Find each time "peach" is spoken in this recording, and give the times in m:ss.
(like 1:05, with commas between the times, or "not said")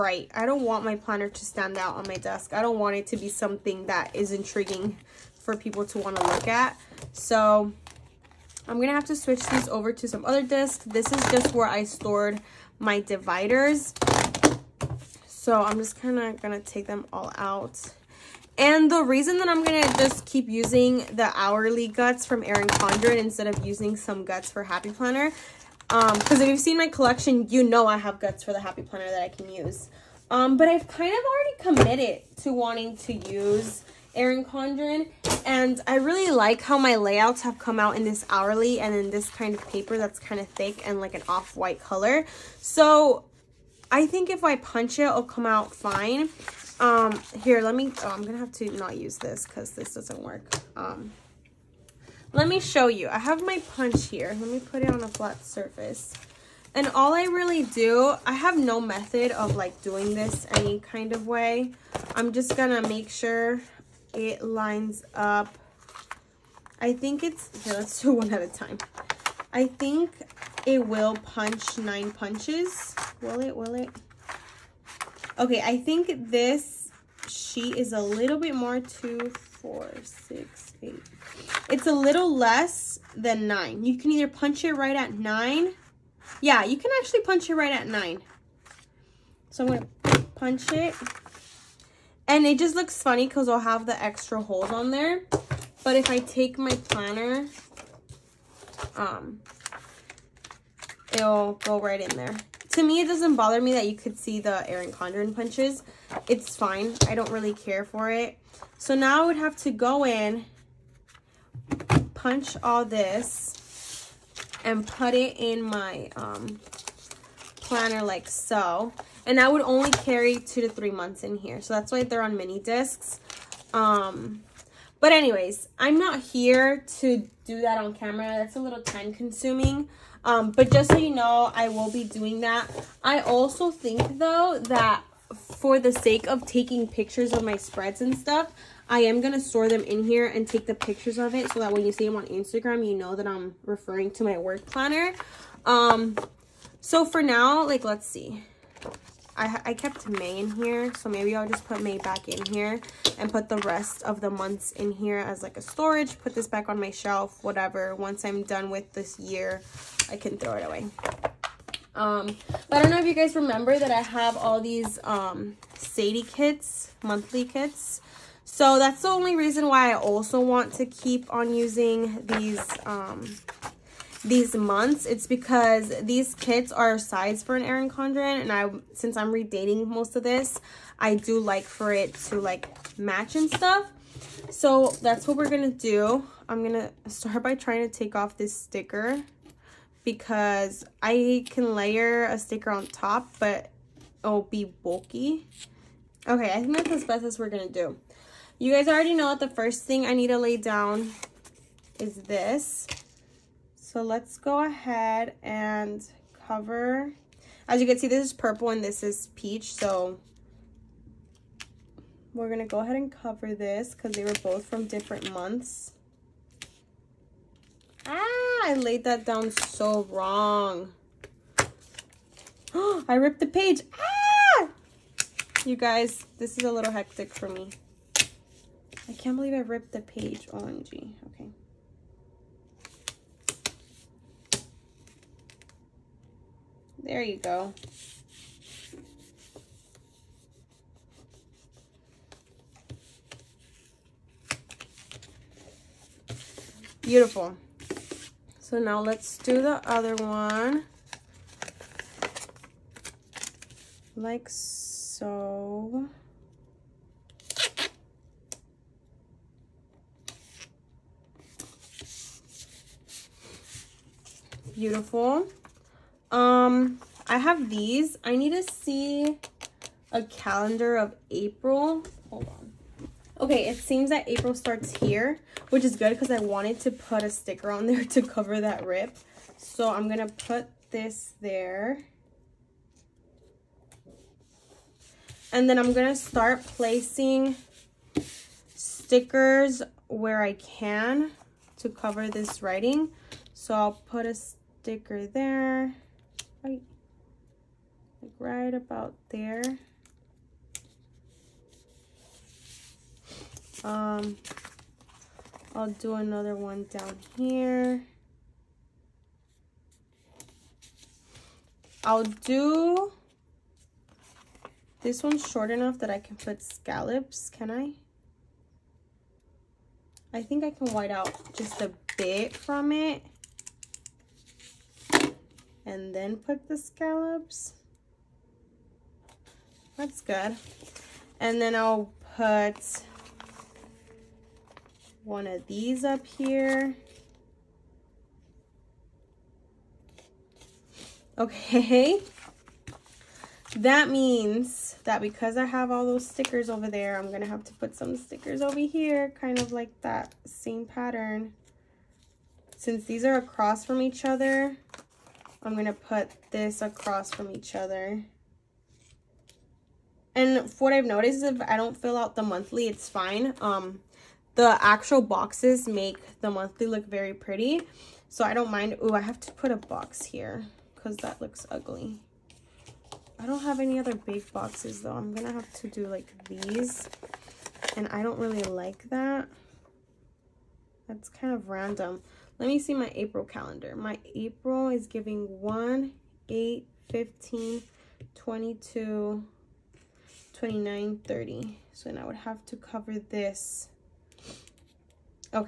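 3:29.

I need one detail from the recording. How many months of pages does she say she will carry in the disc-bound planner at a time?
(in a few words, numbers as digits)
2 to 3.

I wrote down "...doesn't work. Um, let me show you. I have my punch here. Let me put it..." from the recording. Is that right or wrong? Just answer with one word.
right.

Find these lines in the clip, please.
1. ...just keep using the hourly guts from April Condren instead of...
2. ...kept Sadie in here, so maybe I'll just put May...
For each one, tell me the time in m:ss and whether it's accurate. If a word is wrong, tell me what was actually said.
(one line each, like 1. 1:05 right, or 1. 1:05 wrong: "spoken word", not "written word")
1. 0:19 wrong: "Erin", not "April"
2. 2:29 wrong: "May", not "Sadie".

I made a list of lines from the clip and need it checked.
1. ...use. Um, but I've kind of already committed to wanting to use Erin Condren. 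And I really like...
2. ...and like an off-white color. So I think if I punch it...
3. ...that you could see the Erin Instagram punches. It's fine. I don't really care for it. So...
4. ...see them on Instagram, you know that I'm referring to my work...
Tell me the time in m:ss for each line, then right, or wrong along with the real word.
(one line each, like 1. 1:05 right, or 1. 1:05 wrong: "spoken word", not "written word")
1. 0:29 right
2. 0:40 right
3. 1:43 wrong: "Condren", not "Instagram"
4. 2:21 right.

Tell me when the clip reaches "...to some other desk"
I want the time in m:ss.
0:09.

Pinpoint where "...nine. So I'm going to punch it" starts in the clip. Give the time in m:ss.
1:27.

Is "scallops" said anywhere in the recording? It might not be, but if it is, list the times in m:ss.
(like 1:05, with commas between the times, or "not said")
5:16, 5:26.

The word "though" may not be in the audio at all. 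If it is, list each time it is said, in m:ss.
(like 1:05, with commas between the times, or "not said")
2:14, 6:15.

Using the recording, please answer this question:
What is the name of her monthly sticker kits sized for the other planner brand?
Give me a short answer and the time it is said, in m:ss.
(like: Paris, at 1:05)
Sadie, at 2:45.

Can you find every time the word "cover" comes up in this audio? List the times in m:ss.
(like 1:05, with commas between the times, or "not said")
3:26, 3:33, 4:38, 4:51, 6:32.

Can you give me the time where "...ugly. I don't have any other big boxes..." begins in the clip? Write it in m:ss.
6:11.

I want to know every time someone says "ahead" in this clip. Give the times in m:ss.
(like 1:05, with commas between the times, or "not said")
3:24, 3:32.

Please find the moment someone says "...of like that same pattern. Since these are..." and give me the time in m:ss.
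5:49.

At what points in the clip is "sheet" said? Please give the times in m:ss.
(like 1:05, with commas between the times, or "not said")
1:17.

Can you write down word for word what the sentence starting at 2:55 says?
It's because these kits are sized for an Erin Condren.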